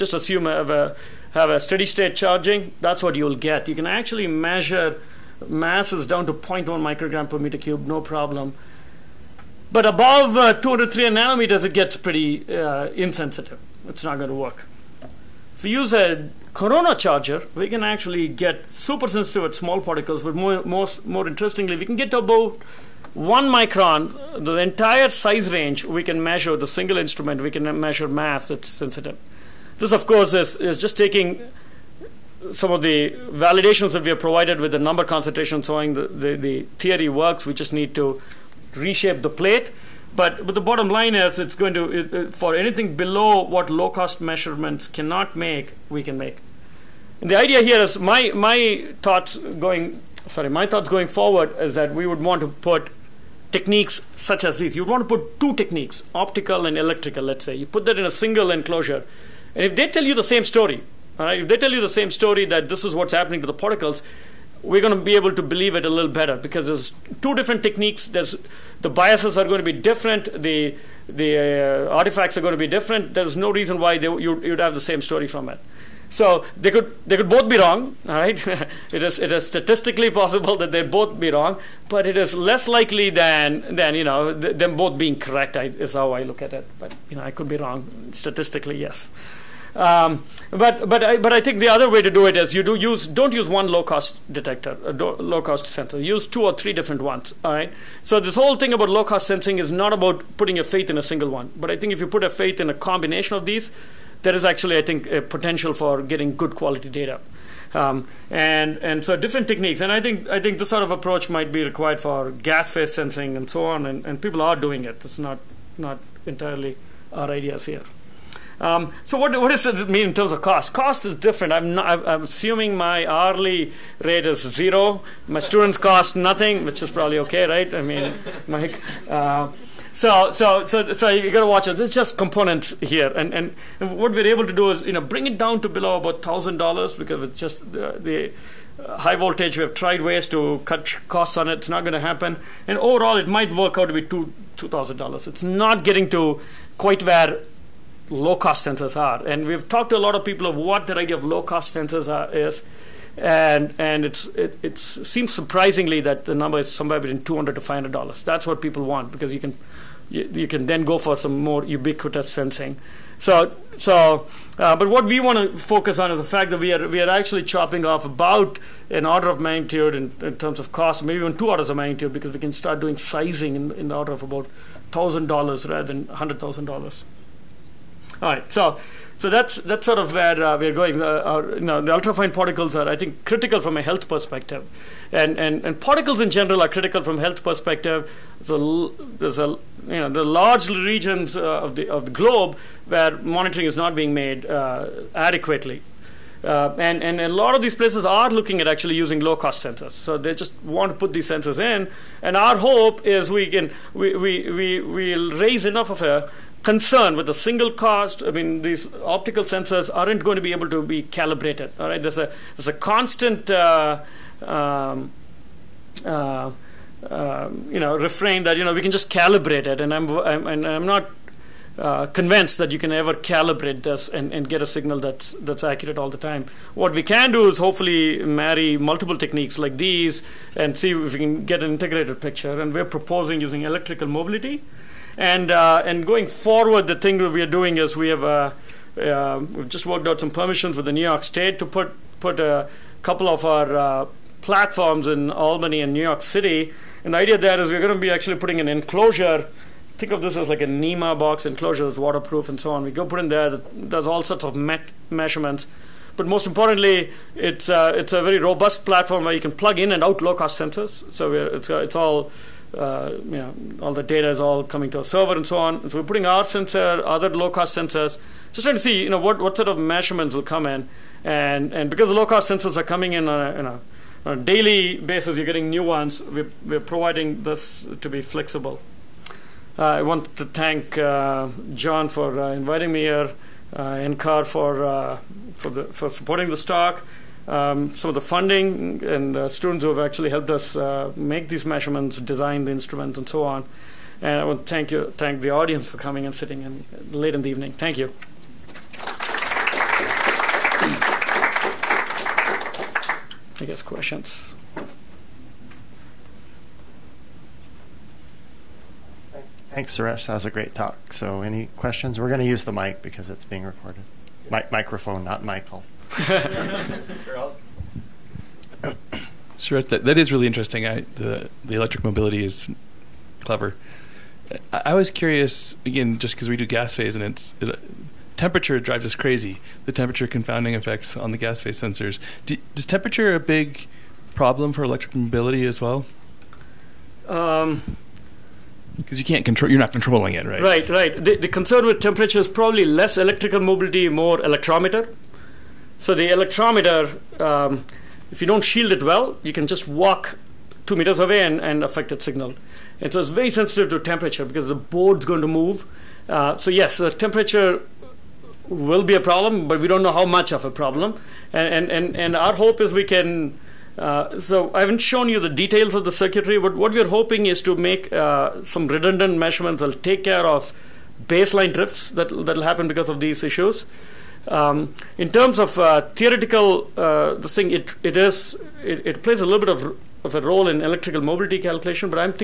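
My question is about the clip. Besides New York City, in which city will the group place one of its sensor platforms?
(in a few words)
Albany.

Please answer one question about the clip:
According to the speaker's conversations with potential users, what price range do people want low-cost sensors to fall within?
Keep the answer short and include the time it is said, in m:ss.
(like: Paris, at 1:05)
$200 to $500, at 2:37.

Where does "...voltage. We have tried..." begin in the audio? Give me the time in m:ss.
2:19.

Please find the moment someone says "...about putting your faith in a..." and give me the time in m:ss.
1:39.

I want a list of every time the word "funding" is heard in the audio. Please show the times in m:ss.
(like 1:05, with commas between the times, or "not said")
4:48.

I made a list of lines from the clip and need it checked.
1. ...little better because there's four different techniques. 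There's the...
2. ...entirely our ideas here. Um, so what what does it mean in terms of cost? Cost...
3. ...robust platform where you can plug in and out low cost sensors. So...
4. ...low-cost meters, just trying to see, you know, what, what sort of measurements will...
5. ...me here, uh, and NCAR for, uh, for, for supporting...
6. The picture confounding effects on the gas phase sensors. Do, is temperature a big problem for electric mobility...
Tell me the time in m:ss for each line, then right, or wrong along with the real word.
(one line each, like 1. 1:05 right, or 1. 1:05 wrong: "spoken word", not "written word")
1. 1:05 wrong: "two", not "four"
2. 1:56 right
3. 4:18 right
4. 4:27 wrong: "sensors", not "meters"
5. 4:42 right
6. 5:29 wrong: "temperature", not "picture".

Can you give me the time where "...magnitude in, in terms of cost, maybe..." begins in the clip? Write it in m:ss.
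2:49.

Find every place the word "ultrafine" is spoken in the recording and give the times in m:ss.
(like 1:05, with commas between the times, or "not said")
3:01.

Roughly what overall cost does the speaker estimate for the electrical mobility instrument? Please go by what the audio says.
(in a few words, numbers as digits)
$2,000.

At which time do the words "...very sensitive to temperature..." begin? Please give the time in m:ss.
5:53.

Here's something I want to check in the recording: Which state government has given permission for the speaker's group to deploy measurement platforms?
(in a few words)
New York State.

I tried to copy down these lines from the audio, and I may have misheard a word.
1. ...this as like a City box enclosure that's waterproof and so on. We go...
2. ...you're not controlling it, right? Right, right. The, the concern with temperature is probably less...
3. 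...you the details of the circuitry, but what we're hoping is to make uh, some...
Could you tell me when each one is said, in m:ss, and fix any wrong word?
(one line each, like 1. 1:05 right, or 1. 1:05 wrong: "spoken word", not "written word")
1. 4:10 wrong: "NEMA", not "City"
2. 5:39 right
3. 6:05 right.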